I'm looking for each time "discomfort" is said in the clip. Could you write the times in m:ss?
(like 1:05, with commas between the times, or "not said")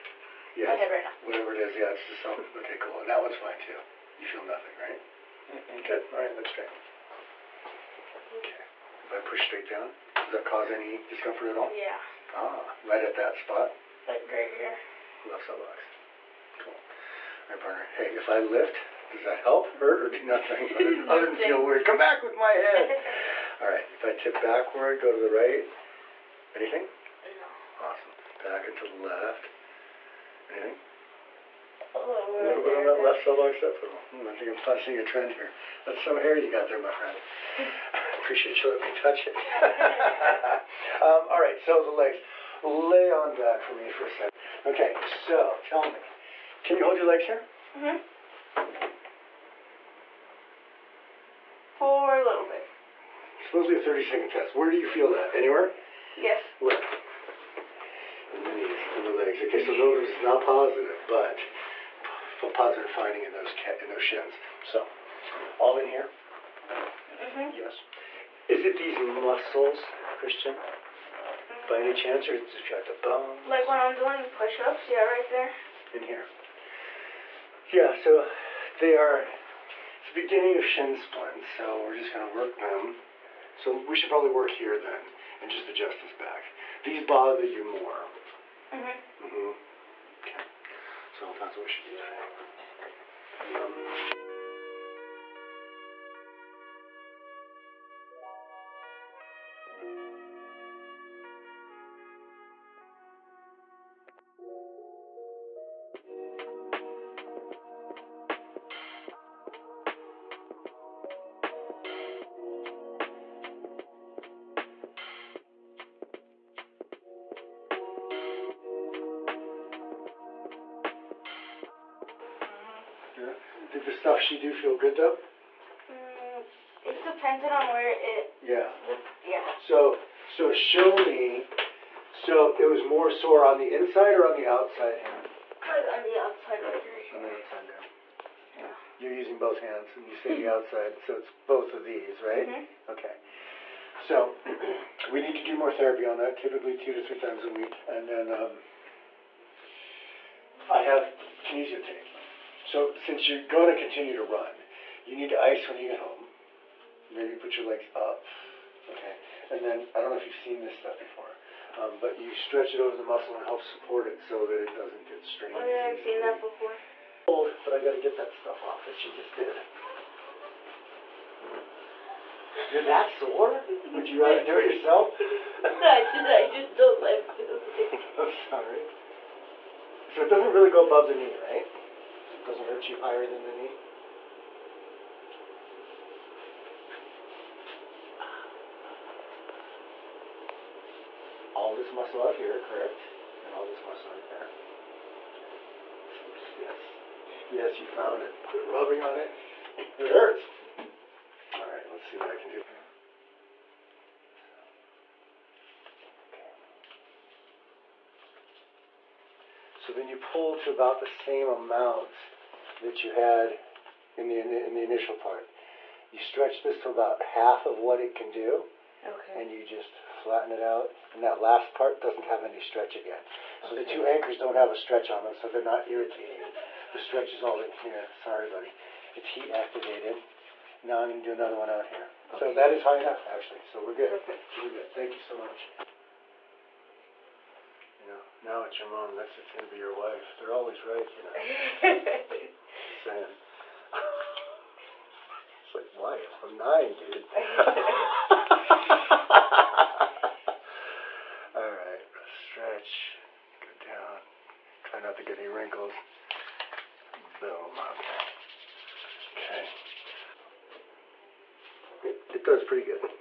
0:11.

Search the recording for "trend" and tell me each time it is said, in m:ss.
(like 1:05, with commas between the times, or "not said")
0:35.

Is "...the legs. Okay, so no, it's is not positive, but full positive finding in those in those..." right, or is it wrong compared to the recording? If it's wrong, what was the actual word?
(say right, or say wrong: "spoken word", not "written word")
right.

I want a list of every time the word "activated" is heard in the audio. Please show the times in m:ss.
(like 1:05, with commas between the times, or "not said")
3:49.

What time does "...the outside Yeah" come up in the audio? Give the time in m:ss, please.
2:17.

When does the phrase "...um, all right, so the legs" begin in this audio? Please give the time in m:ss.
0:41.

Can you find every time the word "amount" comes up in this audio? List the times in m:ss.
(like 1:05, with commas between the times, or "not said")
3:31.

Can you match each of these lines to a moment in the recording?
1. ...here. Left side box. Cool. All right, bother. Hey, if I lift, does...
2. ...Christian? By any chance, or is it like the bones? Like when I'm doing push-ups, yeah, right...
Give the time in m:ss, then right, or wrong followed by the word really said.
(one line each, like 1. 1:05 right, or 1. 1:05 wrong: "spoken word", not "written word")
1. 0:14 wrong: "partner", not "bother"
2. 1:10 right.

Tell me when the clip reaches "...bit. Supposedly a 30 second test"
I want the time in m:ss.
0:52.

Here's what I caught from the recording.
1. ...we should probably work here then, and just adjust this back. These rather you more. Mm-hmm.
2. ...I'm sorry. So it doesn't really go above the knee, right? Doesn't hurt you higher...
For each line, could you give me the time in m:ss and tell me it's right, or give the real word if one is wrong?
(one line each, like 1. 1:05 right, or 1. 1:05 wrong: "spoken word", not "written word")
1. 1:23 wrong: "bother", not "rather"
2. 2:58 right.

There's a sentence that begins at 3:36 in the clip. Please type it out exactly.
You stretch this to about half of what it can do.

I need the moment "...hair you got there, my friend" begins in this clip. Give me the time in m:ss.
0:36.